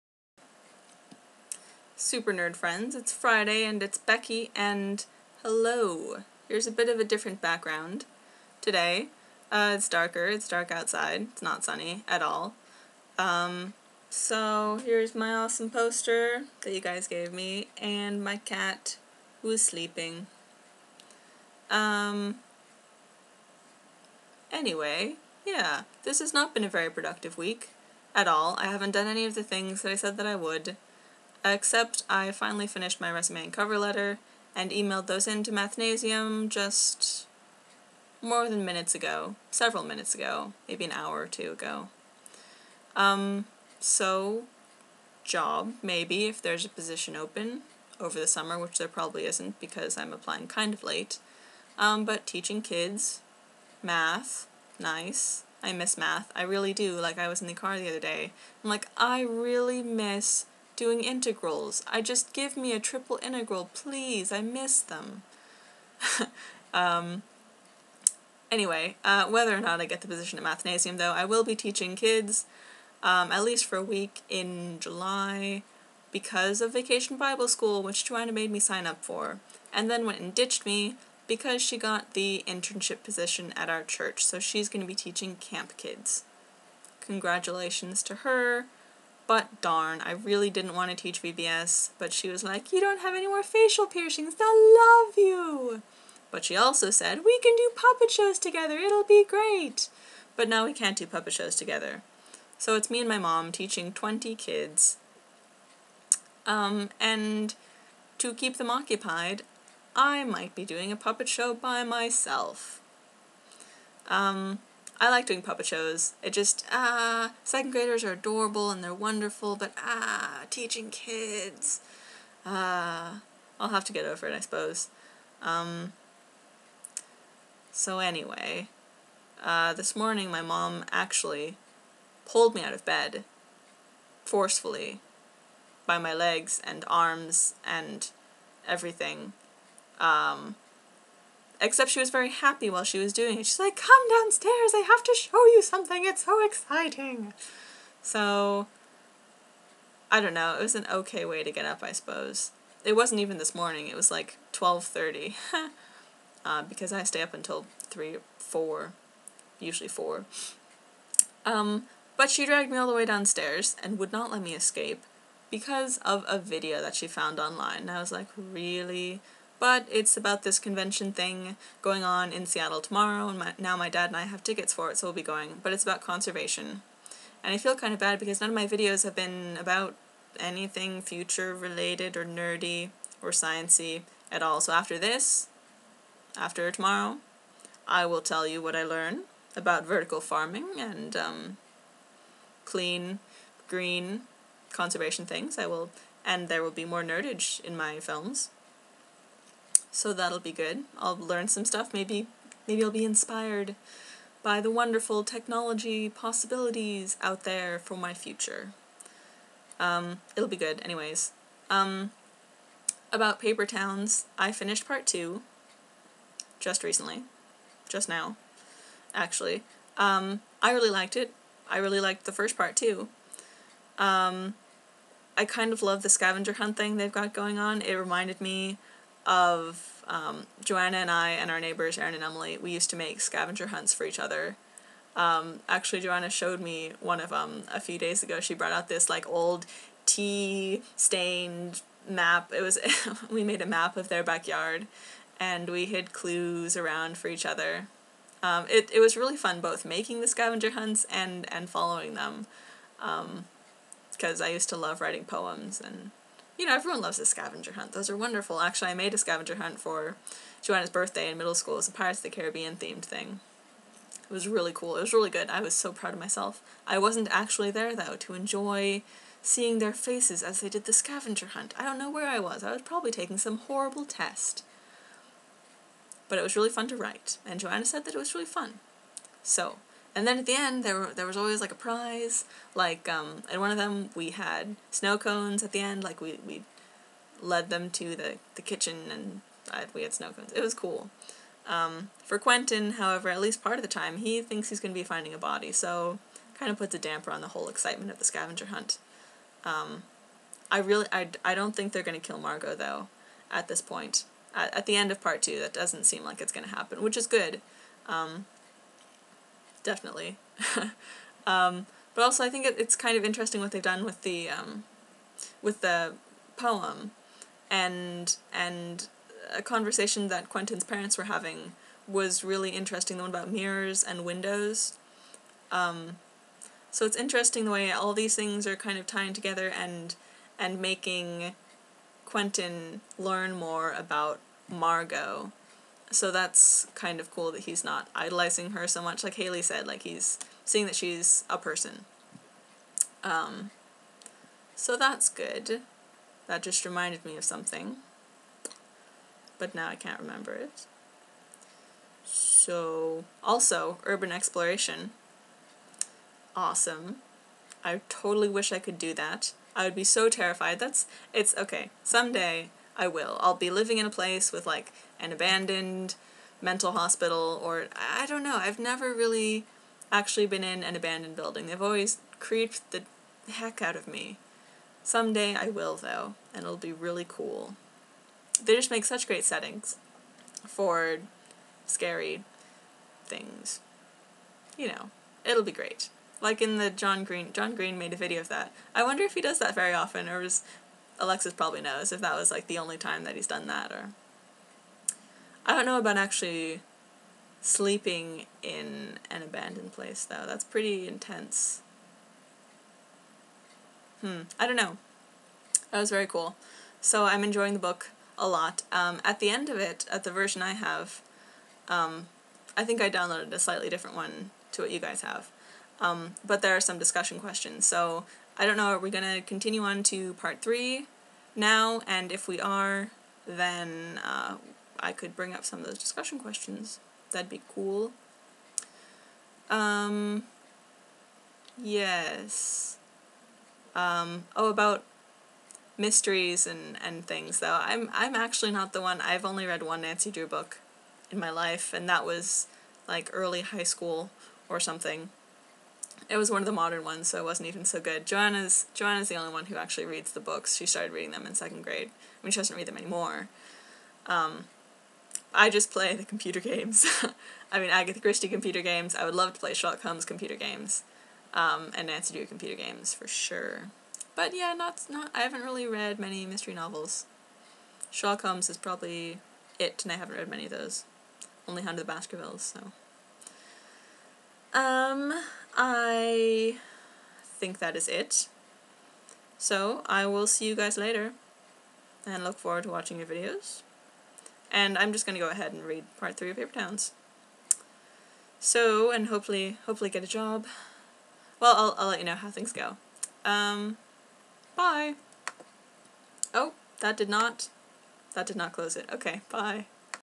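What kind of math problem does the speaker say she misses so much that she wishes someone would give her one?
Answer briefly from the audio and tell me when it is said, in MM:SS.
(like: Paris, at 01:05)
Triple integral, at 01:02.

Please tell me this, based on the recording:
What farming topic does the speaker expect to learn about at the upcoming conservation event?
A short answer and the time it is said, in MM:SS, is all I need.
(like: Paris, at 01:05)
Vertical farming, at 03:09.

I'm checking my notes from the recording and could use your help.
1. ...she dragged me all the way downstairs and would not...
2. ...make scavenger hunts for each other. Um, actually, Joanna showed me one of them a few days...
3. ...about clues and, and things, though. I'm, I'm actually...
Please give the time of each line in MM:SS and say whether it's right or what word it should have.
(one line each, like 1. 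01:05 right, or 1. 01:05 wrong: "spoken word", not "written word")
1. 02:42 right
2. 03:52 right
3. 07:14 wrong: "mysteries", not "clues".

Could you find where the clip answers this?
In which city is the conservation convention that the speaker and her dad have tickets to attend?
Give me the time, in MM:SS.
02:52.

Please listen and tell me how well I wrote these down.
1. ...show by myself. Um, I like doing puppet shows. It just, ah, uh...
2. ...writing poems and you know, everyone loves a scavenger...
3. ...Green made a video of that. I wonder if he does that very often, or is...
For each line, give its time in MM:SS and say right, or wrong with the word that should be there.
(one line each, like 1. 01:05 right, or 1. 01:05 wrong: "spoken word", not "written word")
1. 01:51 right
2. 04:15 right
3. 06:27 right.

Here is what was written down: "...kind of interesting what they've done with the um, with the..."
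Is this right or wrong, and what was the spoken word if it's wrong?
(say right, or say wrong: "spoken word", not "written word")
right.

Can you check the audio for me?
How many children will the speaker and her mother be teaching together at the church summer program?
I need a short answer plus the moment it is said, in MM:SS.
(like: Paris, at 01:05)
20, at 01:43.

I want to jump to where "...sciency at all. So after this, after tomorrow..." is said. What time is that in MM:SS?
03:03.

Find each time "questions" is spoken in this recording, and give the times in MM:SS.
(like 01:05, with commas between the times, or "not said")
06:57, 07:06.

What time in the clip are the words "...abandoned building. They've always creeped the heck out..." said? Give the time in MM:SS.
06:10.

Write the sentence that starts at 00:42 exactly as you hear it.
Um, so, job, maybe, if there's a position open over the summer, which there probably isn't because I'm applying kind of late.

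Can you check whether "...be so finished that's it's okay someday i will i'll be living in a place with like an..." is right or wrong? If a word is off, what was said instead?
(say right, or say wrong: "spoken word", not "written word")
wrong: "terrified", not "finished".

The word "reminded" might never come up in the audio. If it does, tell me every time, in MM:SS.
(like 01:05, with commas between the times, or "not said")
03:47, 05:46.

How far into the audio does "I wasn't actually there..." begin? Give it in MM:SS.
04:26.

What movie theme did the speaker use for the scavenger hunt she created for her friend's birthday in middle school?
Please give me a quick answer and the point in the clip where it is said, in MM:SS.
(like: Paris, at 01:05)
Pirates of the Caribbean, at 04:21.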